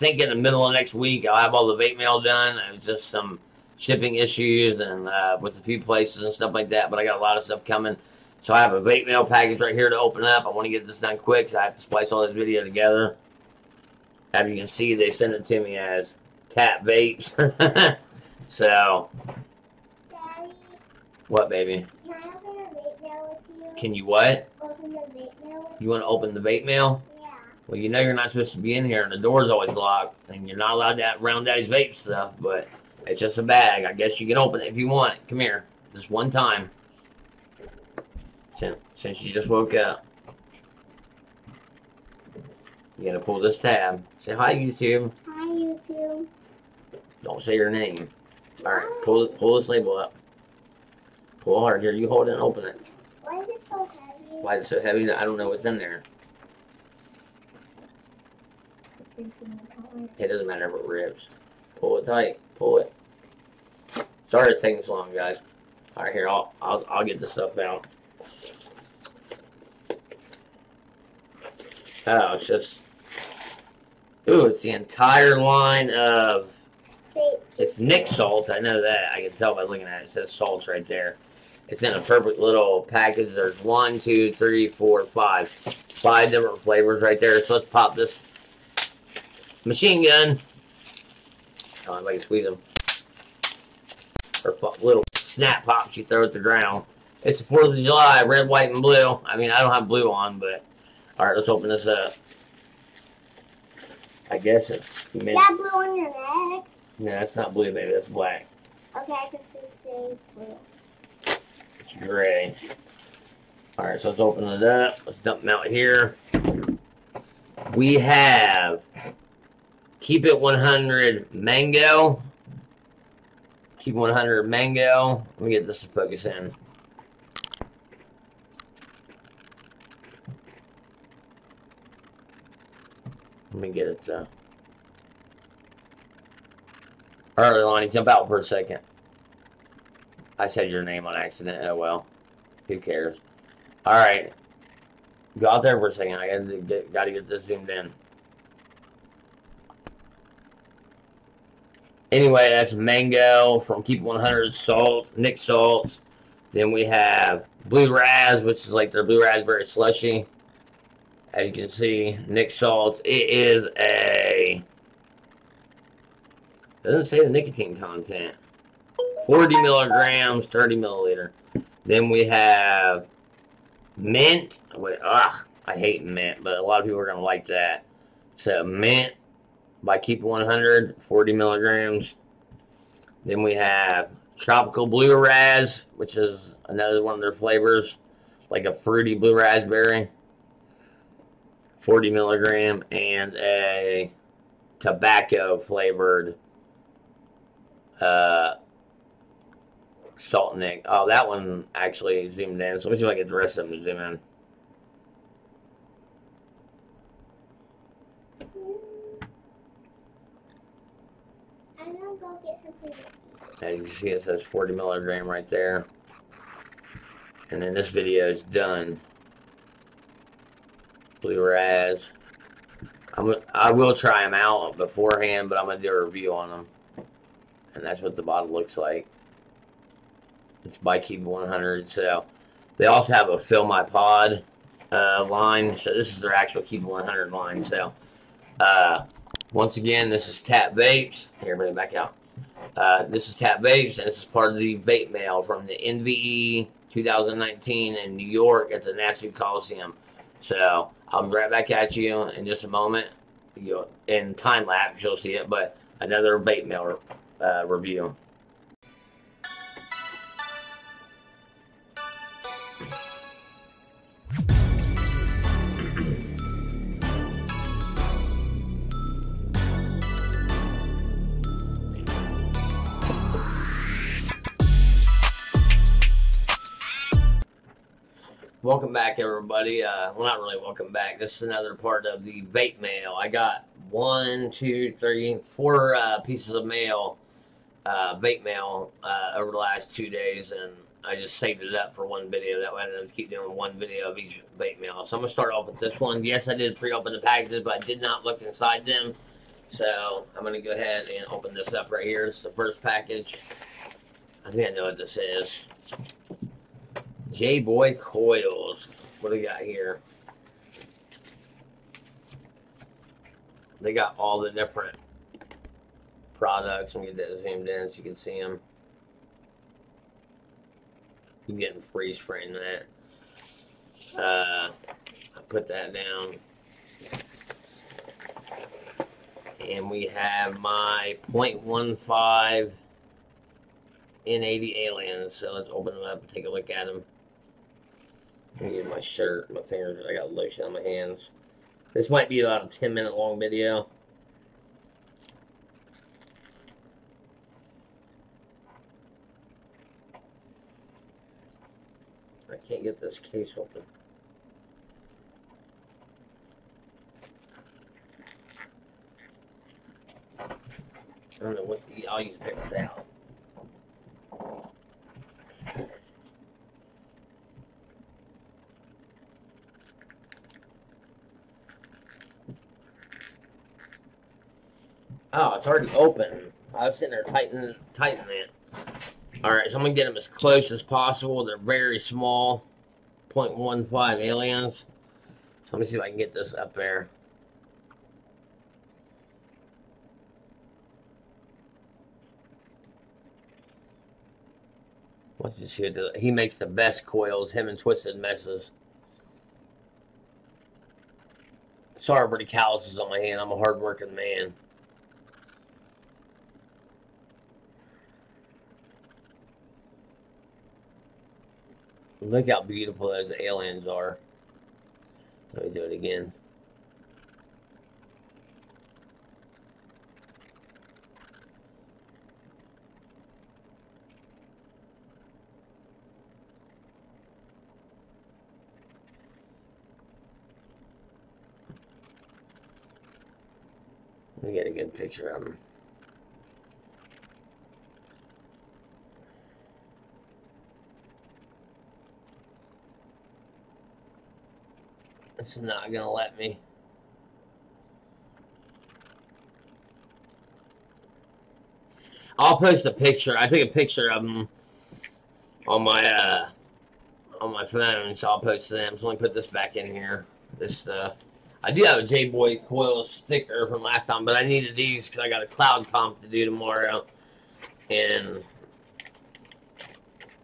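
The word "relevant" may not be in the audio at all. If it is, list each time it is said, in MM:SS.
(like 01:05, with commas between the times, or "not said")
not said.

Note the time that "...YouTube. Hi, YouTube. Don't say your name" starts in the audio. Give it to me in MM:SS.
00:44.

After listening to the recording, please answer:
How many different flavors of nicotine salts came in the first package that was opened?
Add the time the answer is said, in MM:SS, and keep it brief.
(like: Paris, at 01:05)
5, at 01:25.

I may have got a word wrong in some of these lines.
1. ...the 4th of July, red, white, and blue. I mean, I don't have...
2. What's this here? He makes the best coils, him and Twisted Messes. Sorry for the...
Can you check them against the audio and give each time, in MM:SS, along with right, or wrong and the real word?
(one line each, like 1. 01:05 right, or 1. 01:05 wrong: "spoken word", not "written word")
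1. 01:37 right
2. 06:35 right.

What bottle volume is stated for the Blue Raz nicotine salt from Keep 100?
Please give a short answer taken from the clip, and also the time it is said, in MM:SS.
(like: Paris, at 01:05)
30 milliliters, at 02:50.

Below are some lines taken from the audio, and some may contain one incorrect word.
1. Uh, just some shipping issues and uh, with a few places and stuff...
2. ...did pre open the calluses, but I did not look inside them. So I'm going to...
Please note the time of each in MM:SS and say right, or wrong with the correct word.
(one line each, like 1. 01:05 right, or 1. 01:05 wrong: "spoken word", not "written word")
1. 00:02 right
2. 04:56 wrong: "packages", not "calluses".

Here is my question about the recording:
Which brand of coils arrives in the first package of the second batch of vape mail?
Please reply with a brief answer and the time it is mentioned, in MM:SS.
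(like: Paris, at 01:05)
J Boy Coils, at 05:07.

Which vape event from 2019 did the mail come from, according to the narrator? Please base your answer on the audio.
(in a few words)
NVE 2019.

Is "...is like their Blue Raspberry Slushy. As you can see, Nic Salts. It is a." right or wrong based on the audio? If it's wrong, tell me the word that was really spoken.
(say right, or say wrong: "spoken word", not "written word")
right.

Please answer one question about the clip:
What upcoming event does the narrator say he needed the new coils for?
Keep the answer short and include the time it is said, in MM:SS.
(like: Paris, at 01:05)
cloud comp, at 07:45.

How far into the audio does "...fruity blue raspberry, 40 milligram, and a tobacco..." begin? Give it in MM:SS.
03:08.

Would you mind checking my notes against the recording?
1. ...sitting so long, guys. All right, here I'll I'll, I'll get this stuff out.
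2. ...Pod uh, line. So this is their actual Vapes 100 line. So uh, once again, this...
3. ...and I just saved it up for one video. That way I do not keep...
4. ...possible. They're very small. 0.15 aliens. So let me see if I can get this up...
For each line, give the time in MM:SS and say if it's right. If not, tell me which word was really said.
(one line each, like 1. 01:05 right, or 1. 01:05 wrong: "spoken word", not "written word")
1. 01:04 wrong: "taking", not "sitting"
2. 03:53 wrong: "Keep", not "Vapes"
3. 04:50 right
4. 06:20 right.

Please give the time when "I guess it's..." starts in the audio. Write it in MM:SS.
01:44.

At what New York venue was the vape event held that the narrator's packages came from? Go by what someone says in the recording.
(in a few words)
Nassau Coliseum.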